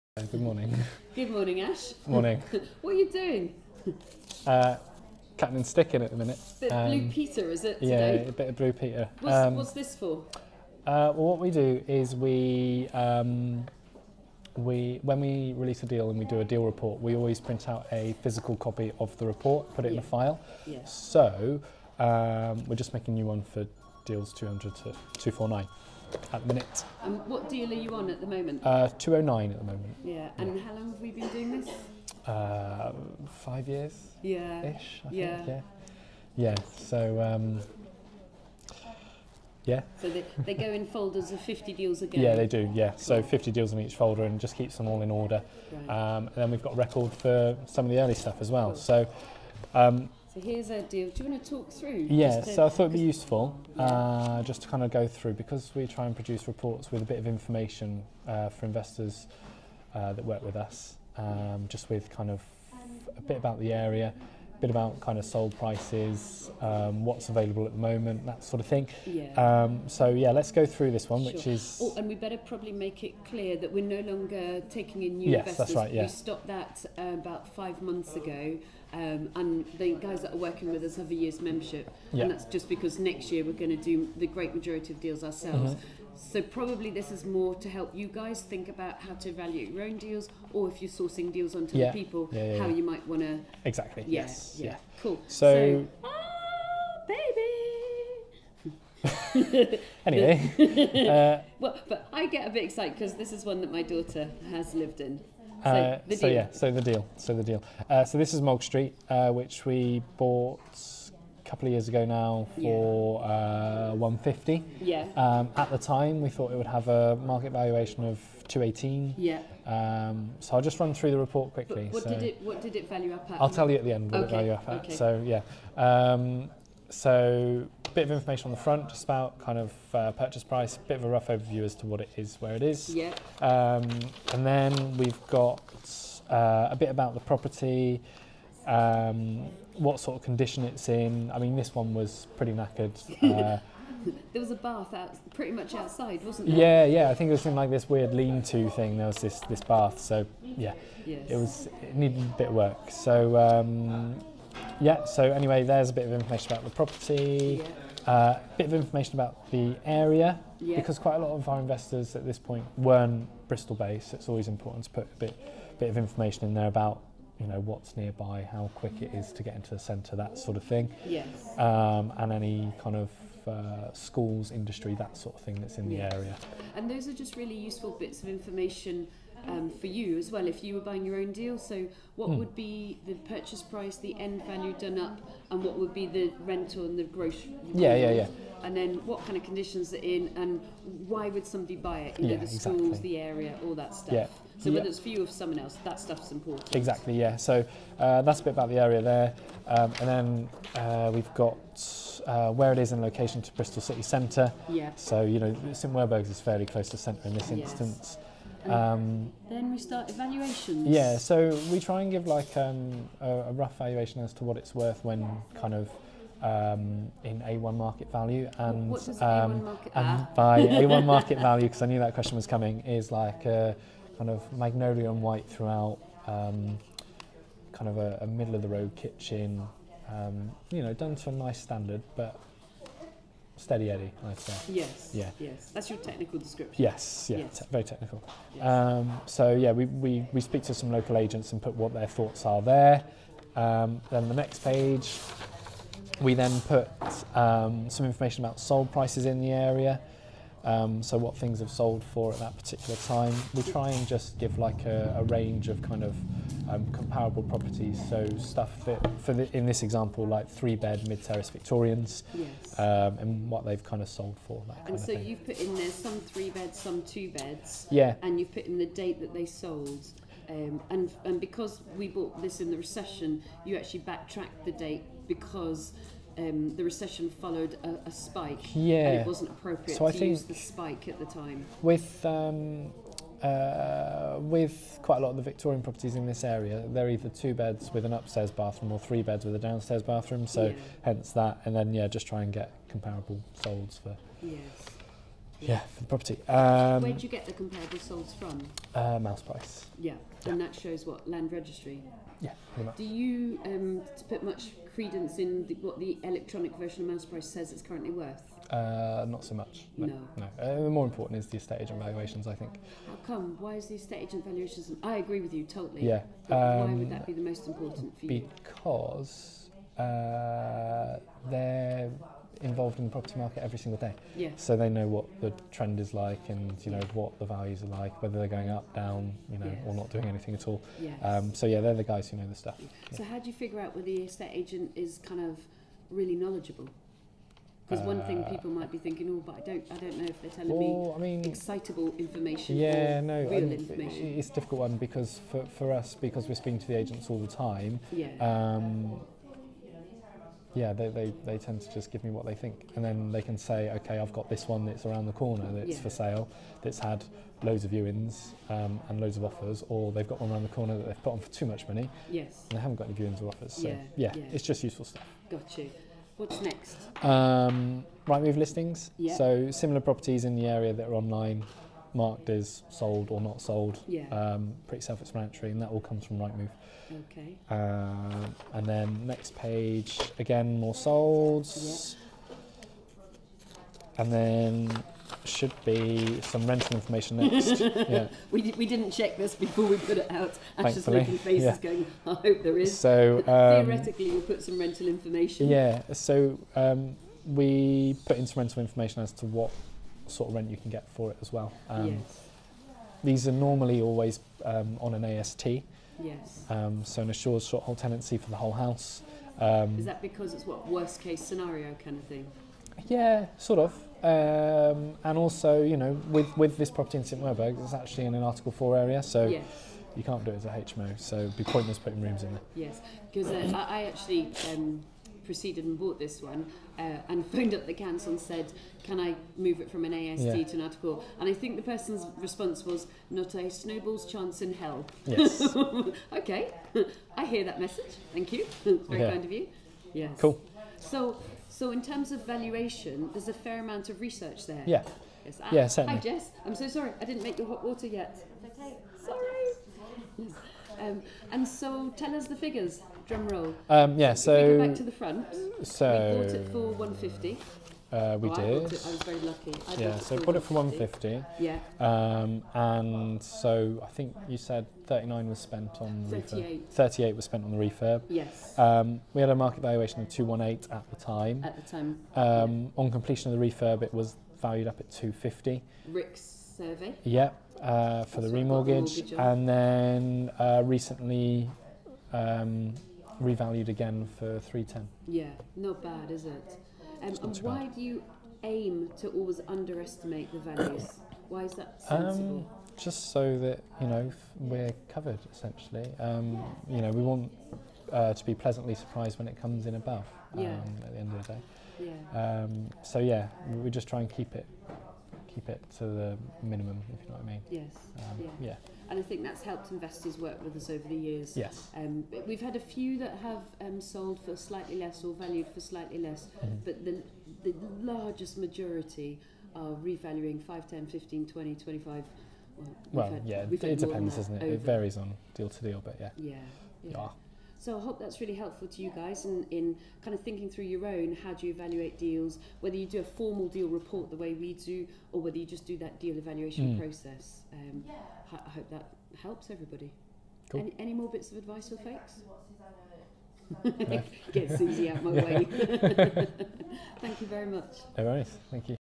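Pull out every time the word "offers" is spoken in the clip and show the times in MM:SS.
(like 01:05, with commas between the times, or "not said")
05:59, 06:03.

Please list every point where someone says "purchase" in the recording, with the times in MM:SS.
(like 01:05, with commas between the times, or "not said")
02:10, 03:03.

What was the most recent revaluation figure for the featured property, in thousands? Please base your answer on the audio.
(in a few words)
310.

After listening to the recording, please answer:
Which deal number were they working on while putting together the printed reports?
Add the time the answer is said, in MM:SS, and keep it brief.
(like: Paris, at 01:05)
209, at 00:28.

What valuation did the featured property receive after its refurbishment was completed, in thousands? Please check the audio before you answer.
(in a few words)
250.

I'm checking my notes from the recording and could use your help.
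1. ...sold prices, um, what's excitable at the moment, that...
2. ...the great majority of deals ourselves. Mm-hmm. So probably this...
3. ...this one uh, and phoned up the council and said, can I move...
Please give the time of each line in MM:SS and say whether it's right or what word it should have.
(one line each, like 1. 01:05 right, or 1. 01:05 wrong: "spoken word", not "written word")
1. 01:05 wrong: "available", not "excitable"
2. 01:24 right
3. 07:06 right.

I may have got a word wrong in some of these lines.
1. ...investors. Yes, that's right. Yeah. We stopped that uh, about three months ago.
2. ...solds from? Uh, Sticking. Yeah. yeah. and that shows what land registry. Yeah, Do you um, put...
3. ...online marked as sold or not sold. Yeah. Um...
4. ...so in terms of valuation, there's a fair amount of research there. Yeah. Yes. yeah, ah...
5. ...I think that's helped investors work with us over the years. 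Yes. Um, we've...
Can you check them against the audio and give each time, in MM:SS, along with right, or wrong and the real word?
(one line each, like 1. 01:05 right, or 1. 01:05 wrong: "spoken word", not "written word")
1. 01:15 wrong: "five", not "three"
2. 04:57 wrong: "Mouseprice", not "Sticking"
3. 06:11 right
4. 07:21 right
5. 08:29 right.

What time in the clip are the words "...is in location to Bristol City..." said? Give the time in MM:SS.
03:22.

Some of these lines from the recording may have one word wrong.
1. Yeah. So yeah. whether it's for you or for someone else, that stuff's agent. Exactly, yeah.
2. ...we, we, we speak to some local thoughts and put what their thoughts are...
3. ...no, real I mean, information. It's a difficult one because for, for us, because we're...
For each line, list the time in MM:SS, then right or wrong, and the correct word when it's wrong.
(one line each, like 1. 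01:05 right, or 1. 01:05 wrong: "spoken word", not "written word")
1. 03:14 wrong: "important", not "agent"
2. 03:59 wrong: "agents", not "thoughts"
3. 05:43 right.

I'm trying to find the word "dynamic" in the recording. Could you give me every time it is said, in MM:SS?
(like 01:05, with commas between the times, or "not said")
not said.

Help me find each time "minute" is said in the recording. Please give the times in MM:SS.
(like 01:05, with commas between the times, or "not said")
00:06, 00:26.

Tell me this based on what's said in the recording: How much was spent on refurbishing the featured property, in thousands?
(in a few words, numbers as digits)
38.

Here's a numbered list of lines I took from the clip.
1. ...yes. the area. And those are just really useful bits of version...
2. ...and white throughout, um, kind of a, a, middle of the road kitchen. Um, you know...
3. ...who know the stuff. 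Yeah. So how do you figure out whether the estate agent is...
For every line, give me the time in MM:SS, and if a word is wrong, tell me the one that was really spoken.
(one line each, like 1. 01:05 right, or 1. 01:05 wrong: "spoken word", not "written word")
1. 02:55 wrong: "information", not "version"
2. 03:45 right
3. 05:32 right.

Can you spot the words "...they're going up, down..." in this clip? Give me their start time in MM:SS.
05:28.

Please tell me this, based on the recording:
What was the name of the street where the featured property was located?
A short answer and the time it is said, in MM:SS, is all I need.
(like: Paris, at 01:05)
Mulg Street, at 01:48.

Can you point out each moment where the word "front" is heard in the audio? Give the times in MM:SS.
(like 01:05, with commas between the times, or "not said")
02:08, 07:35.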